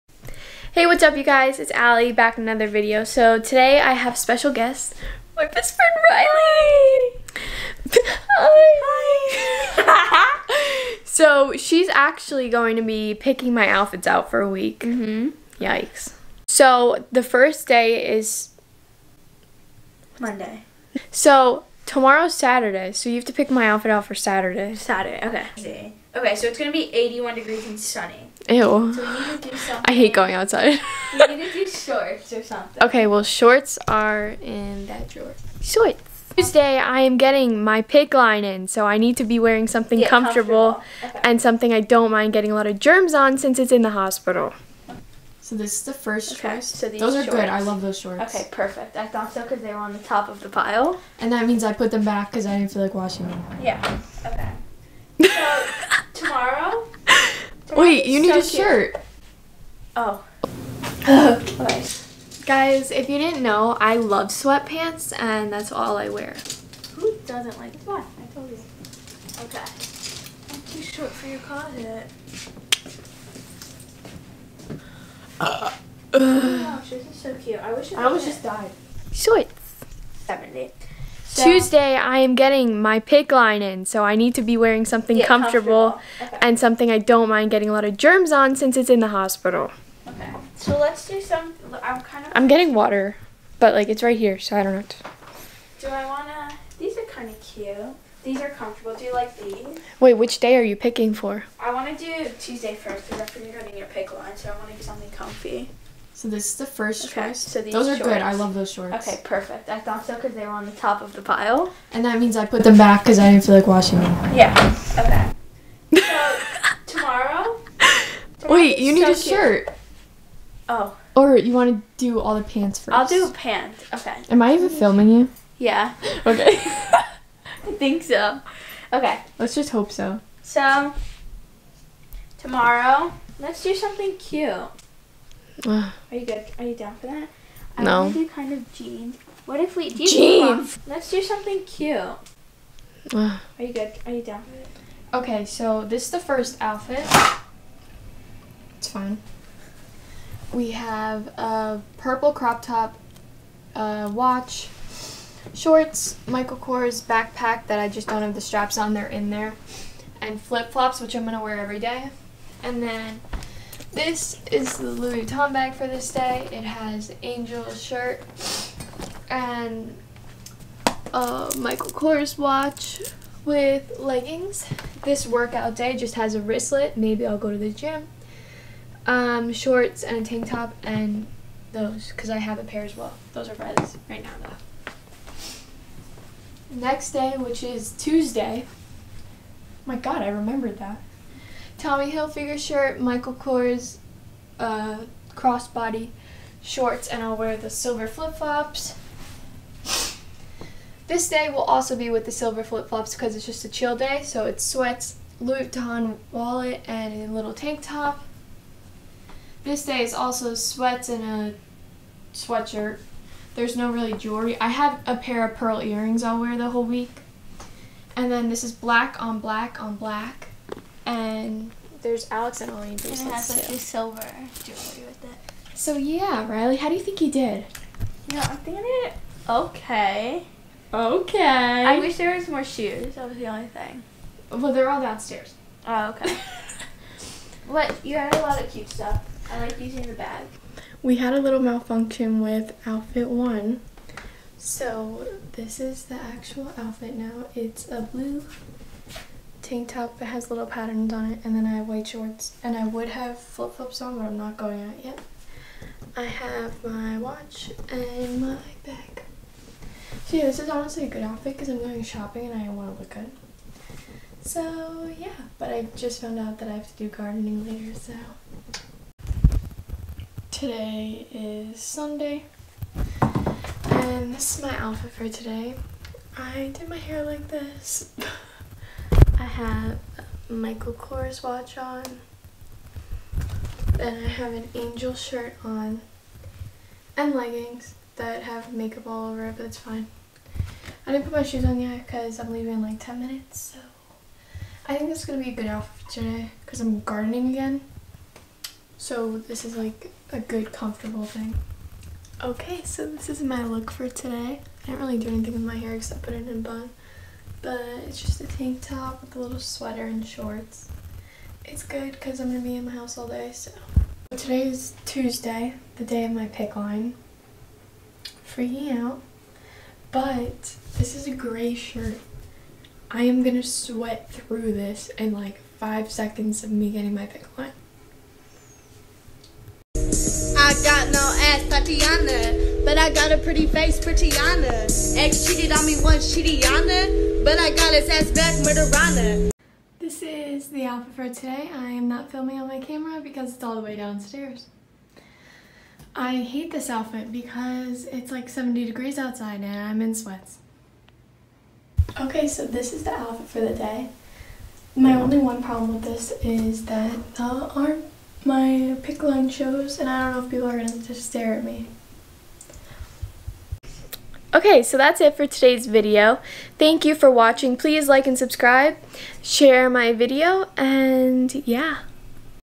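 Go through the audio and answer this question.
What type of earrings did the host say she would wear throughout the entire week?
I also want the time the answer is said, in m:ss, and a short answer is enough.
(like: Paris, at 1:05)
Pearl earrings, at 3:35.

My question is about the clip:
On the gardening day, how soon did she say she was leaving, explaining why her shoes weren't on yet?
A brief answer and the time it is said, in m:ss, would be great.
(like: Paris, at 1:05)
10 minutes, at 4:52.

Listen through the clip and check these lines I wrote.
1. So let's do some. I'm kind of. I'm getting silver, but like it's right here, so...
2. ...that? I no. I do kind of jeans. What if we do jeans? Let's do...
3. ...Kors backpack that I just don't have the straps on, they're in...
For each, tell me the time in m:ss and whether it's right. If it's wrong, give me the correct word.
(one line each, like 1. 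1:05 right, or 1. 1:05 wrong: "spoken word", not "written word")
1. 1:30 wrong: "water", not "silver"
2. 2:17 right
3. 2:36 right.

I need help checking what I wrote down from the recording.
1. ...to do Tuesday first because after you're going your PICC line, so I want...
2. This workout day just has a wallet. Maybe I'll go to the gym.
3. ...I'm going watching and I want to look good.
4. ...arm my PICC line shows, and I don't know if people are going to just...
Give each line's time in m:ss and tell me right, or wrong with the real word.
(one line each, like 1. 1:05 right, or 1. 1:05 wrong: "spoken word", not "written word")
1. 1:41 right
2. 2:55 wrong: "wristlet", not "wallet"
3. 4:21 wrong: "shopping", not "watching"
4. 5:57 right.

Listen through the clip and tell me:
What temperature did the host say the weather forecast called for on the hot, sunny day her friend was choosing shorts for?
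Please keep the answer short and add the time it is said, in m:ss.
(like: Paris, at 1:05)
81 degrees, at 0:26.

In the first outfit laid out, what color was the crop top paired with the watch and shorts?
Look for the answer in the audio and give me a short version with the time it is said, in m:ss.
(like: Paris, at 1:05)
Purple, at 2:31.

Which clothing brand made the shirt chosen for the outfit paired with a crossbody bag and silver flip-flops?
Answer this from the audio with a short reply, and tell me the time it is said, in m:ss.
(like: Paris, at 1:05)
Tommy Hilfiger, at 3:11.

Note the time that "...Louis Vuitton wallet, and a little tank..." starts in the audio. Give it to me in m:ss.
3:25.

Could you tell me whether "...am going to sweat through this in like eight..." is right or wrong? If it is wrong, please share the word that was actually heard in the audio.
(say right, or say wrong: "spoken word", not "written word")
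wrong: "five", not "eight".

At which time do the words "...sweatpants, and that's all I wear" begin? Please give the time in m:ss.
1:04.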